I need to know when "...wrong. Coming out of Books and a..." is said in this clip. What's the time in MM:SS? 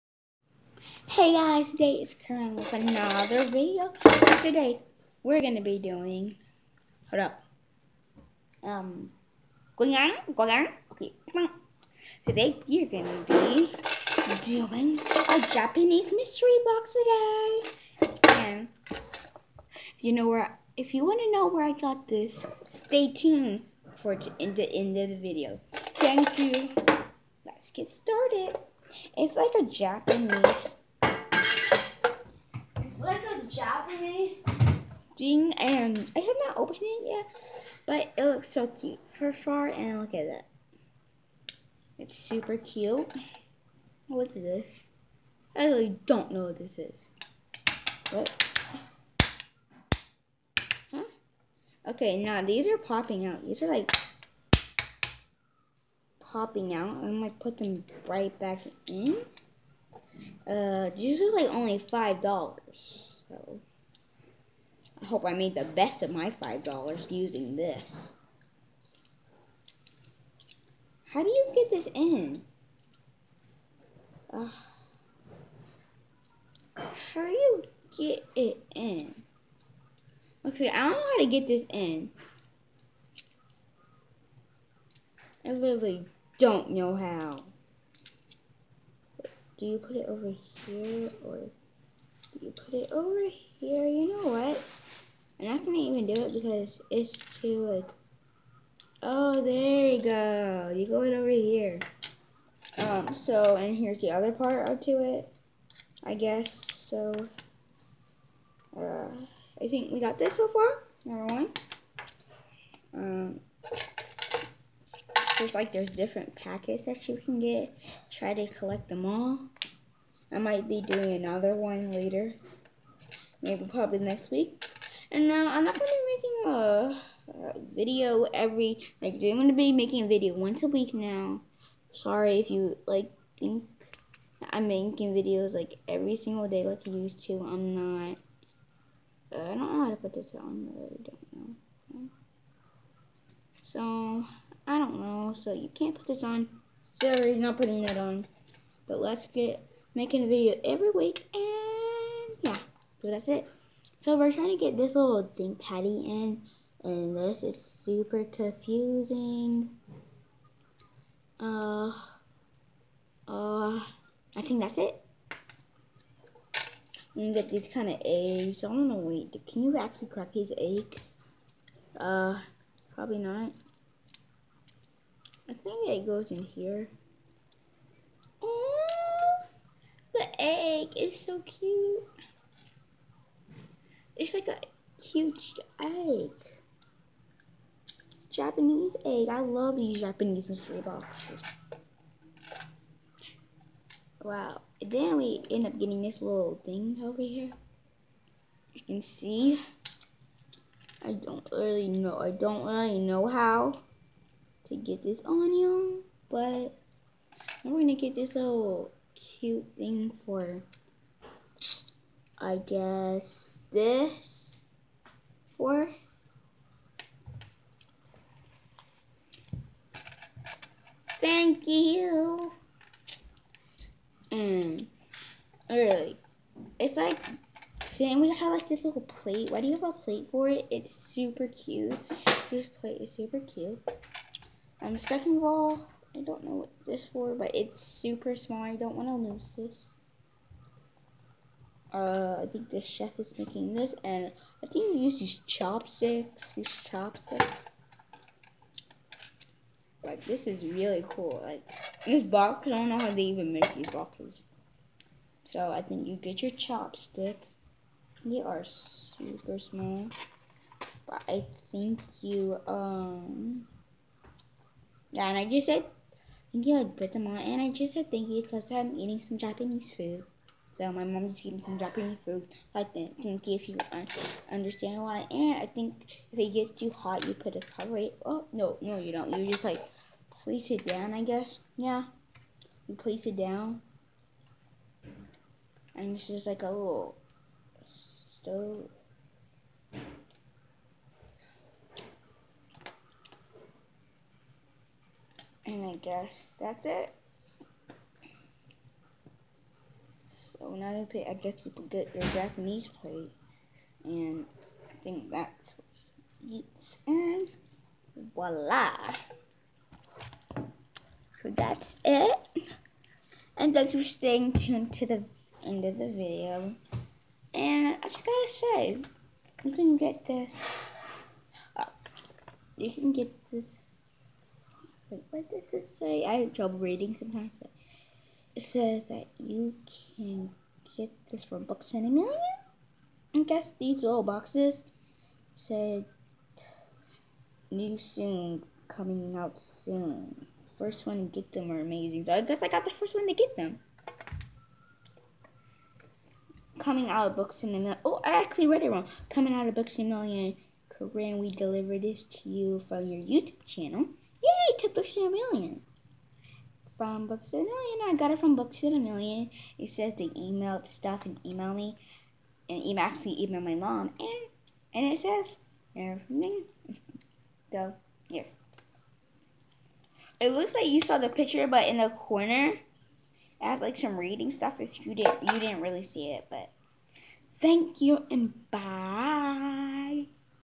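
05:48.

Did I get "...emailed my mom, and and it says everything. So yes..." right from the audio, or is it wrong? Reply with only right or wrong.
right.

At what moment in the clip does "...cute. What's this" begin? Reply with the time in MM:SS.
00:42.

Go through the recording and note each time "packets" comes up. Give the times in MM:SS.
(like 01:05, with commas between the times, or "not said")
01:56.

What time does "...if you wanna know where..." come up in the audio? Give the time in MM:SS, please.
00:20.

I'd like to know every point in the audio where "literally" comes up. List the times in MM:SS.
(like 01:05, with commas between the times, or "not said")
01:25.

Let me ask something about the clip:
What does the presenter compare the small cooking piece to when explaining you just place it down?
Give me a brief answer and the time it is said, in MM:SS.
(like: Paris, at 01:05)
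a little stove, at 04:46.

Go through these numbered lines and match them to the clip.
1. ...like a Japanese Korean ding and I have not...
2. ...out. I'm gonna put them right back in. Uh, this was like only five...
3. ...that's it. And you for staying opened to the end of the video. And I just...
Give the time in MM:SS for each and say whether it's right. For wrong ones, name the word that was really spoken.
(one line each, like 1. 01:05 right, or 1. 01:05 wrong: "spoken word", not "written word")
1. 00:29 wrong: "Japanese", not "Korean"
2. 00:56 right
3. 05:11 wrong: "tuned", not "opened".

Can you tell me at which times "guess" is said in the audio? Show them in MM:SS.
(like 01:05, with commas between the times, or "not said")
01:46, 03:32, 04:41, 04:56, 05:01, 05:33, 05:42.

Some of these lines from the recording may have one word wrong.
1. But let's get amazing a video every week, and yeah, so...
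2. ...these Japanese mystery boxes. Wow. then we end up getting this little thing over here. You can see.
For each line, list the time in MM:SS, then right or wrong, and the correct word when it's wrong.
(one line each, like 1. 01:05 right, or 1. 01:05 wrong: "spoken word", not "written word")
1. 02:28 wrong: "making", not "amazing"
2. 03:09 right.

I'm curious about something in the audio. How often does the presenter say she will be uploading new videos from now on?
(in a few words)
once a week.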